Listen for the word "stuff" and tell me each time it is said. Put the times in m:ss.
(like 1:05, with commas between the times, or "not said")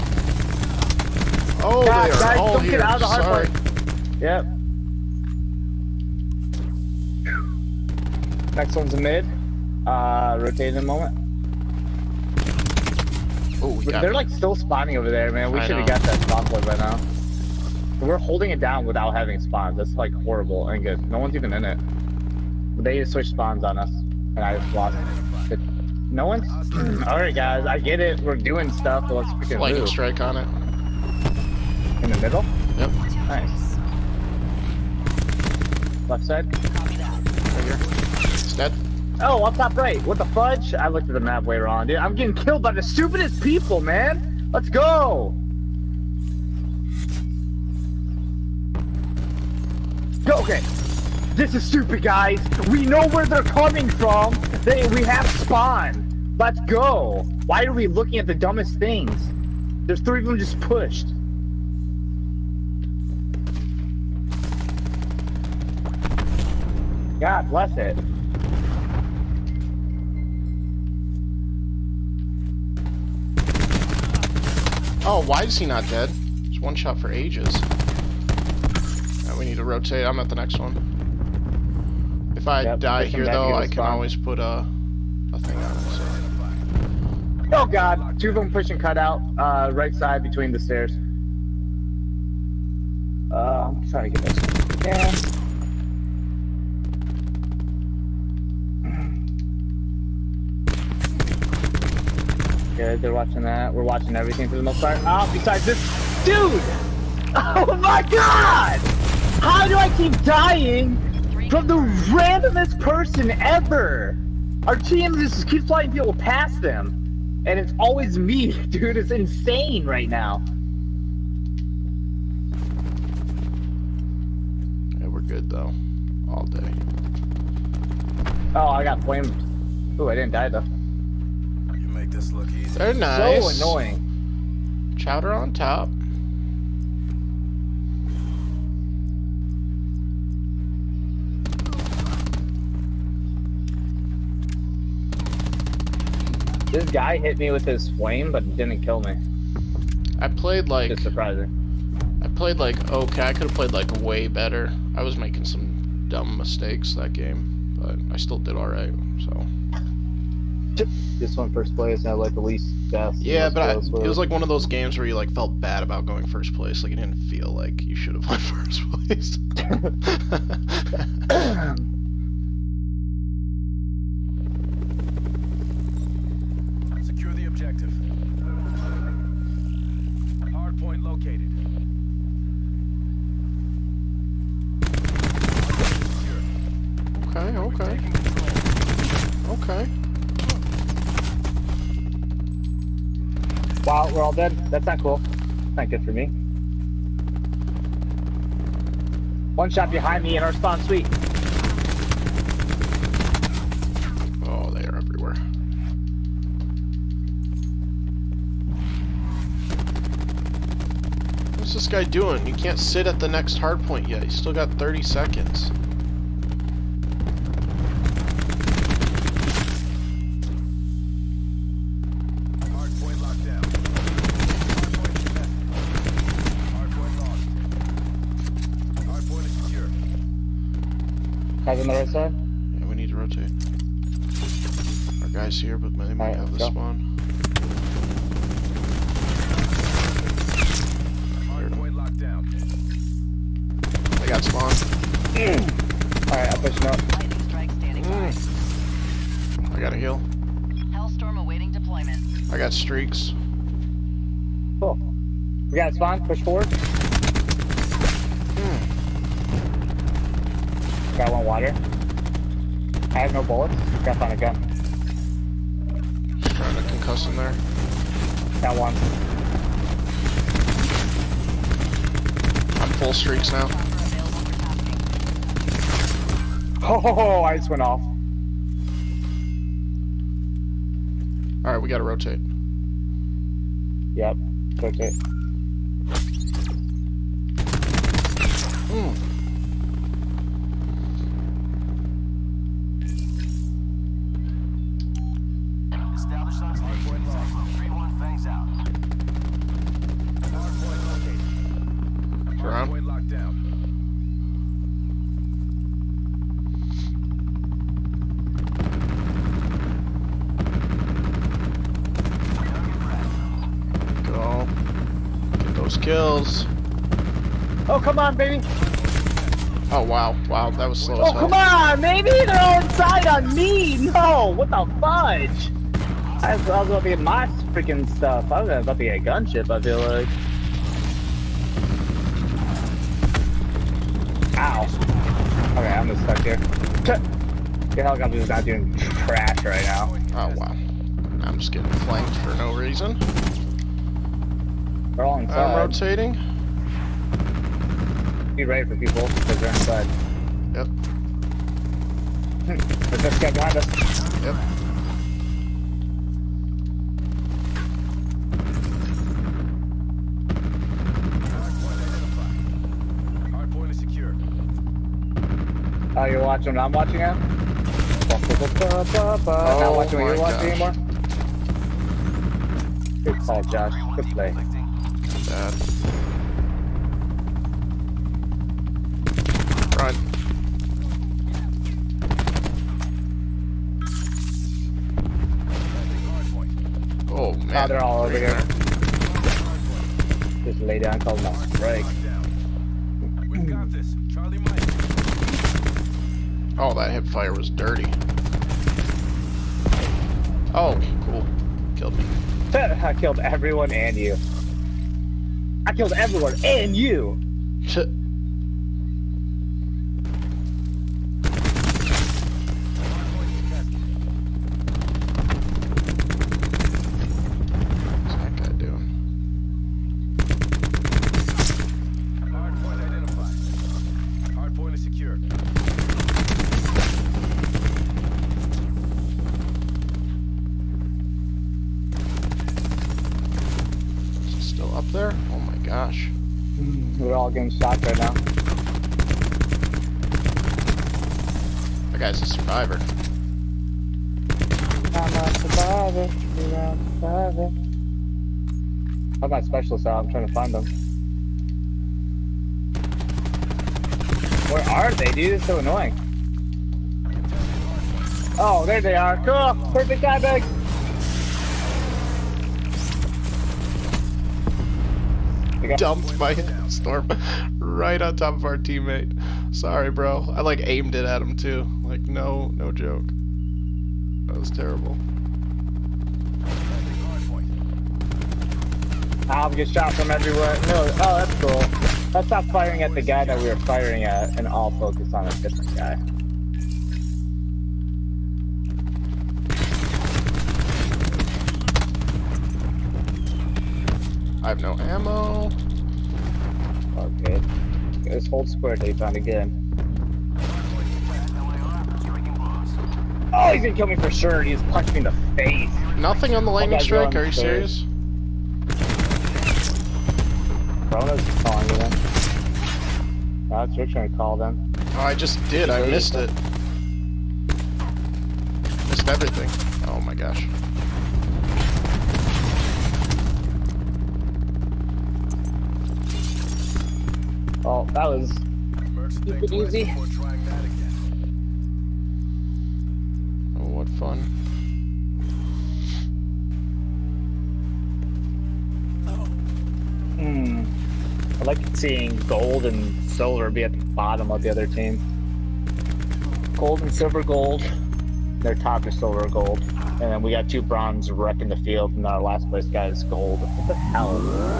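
0:28, 5:28.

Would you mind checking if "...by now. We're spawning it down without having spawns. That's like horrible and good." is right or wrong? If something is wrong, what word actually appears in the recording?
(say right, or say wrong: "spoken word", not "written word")
wrong: "holding", not "spawning".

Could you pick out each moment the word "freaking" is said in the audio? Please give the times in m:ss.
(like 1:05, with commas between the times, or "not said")
0:29, 5:27.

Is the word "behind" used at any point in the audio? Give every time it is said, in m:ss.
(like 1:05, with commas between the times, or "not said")
3:19, 5:53.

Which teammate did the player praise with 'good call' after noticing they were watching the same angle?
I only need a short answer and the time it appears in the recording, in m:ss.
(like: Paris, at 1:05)
Josh, at 6:13.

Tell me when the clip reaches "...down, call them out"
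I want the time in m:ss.
6:30.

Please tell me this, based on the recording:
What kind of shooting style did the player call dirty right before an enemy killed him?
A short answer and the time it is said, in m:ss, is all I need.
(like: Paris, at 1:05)
Hip fire, at 6:37.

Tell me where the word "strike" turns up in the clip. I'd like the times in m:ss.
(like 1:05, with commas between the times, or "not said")
0:29, 8:27.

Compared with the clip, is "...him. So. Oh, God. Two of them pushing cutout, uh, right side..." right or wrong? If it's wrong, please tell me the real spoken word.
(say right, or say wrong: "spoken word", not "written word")
right.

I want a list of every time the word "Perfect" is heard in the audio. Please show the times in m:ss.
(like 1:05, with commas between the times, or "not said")
7:39.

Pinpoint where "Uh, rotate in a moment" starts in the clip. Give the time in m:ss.
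0:09.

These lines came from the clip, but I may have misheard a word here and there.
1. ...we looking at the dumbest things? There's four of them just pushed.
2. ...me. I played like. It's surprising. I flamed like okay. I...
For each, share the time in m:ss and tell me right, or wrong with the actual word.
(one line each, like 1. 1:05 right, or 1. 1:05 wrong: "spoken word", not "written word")
1. 0:57 wrong: "three", not "four"
2. 2:29 wrong: "played", not "flamed".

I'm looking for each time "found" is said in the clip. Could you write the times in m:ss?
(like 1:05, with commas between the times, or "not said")
8:19.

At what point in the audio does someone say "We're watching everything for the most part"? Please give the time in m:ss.
1:43.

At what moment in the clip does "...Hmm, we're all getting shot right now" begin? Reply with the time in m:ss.
7:16.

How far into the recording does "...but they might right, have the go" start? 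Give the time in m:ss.
3:55.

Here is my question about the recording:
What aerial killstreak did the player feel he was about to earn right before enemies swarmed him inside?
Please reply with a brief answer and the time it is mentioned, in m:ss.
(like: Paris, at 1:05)
Gunship, at 5:29.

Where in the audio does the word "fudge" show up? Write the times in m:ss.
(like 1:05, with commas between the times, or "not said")
0:40, 5:24.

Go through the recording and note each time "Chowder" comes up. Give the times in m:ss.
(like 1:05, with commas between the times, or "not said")
2:14.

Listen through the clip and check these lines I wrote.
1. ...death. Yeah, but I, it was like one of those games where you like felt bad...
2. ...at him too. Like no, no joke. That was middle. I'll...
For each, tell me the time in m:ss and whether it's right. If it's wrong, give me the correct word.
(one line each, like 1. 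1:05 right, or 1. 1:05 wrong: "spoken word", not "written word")
1. 2:42 right
2. 7:51 wrong: "terrible", not "middle".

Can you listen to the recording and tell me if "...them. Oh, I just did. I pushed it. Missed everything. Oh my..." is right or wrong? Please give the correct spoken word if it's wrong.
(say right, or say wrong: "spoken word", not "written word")
wrong: "missed", not "pushed".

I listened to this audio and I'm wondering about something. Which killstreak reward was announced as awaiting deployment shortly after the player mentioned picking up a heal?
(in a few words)
Hellstorm.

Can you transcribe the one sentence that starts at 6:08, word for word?
Oh Not watching what you're oh gosh.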